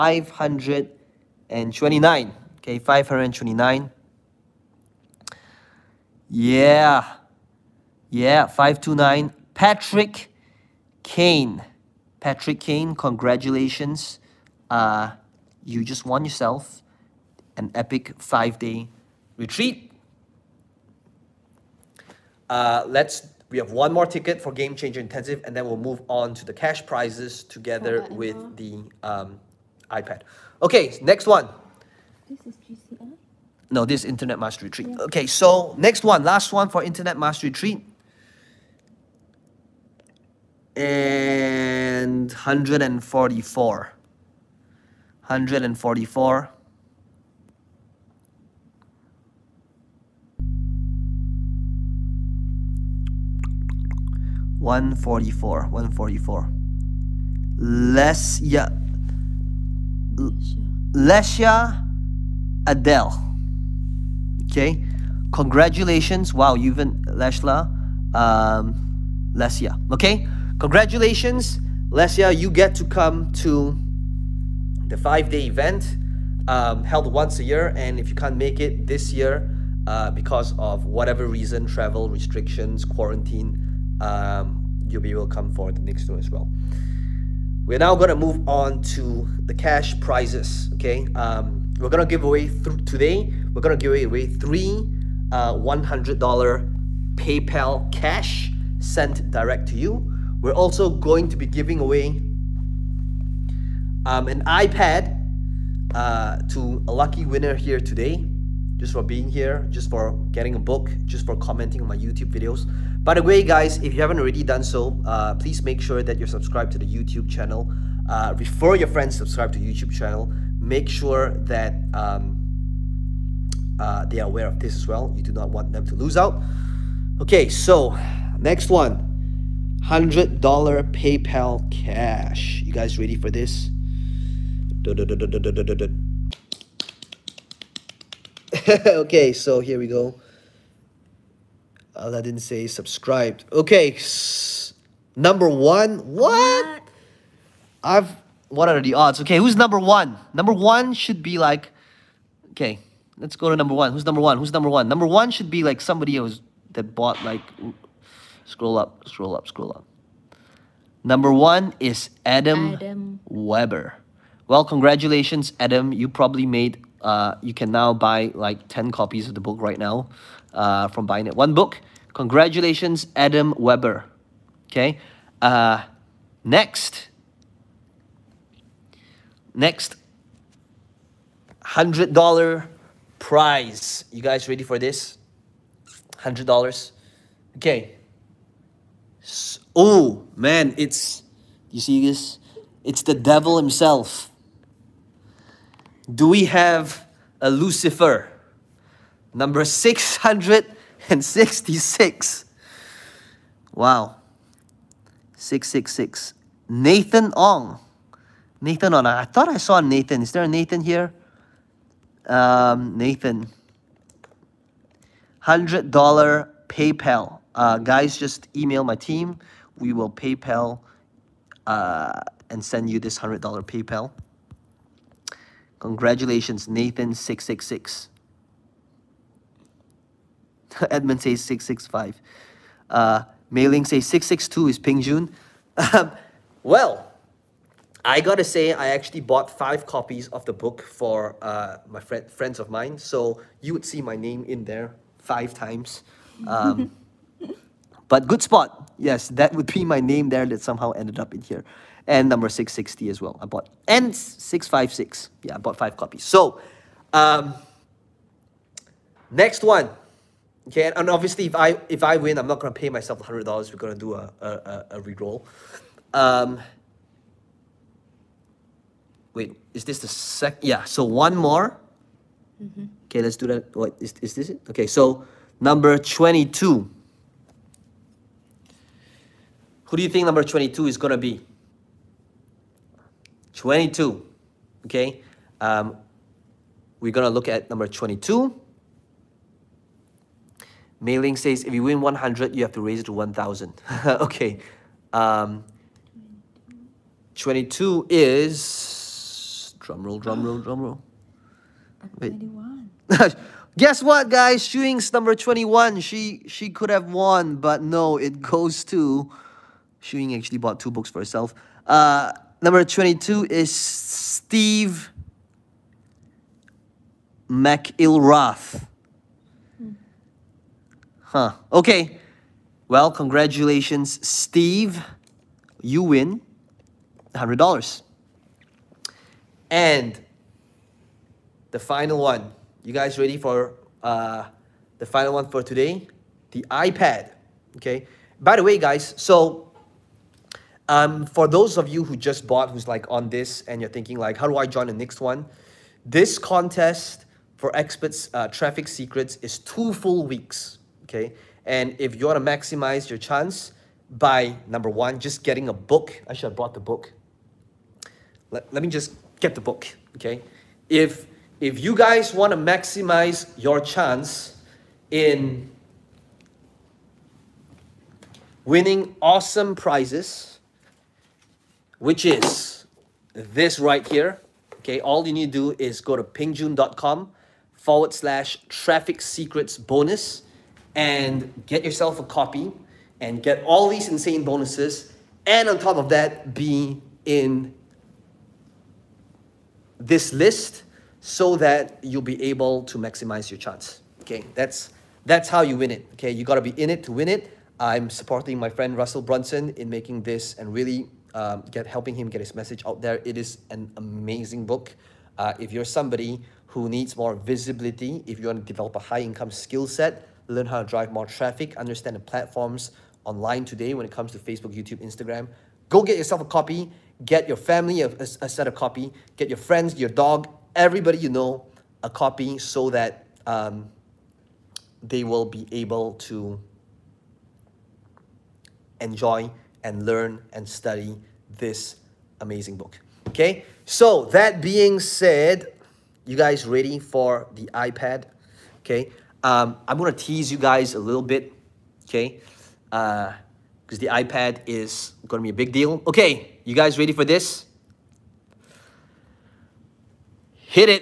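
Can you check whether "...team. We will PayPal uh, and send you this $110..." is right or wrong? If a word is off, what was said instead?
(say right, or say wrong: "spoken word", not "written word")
wrong: "100", not "110".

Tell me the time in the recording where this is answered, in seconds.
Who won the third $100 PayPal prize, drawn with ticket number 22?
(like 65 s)
313 s.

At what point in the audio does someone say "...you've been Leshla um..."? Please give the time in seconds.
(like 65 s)
66 s.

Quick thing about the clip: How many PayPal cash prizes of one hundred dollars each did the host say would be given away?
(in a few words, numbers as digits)
3.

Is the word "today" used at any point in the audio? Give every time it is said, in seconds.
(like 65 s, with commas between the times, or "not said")
92 s, 107 s, 335 s, 413 s.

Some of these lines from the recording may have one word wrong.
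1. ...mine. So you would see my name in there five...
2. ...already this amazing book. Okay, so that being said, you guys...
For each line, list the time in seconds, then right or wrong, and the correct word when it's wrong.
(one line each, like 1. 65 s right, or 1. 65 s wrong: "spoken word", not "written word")
1. 242 s right
2. 430 s wrong: "study", not "already".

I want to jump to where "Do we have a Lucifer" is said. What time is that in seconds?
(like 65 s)
196 s.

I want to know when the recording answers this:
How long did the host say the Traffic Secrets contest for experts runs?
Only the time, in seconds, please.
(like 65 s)
349 s.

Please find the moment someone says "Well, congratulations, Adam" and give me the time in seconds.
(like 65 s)
164 s.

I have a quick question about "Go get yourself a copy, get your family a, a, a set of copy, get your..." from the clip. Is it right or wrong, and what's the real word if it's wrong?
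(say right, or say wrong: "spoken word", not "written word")
right.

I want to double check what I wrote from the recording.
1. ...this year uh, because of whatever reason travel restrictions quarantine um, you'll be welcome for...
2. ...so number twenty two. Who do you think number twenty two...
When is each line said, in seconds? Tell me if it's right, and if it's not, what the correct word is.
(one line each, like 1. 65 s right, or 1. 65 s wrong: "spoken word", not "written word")
1. 78 s right
2. 274 s right.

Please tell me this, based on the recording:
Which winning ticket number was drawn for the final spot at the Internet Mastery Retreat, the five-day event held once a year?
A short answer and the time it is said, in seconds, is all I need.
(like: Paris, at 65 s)
144, at 40 s.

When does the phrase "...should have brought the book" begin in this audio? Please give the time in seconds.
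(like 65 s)
356 s.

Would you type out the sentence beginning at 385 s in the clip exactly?
And on top of that, be in this list so that you'll be able to maximize your chance.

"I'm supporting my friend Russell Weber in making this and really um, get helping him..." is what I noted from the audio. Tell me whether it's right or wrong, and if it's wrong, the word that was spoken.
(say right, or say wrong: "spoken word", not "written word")
wrong: "Brunson", not "Weber".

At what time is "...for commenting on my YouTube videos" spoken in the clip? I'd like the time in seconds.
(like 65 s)
111 s.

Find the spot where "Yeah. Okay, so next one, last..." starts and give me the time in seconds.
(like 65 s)
34 s.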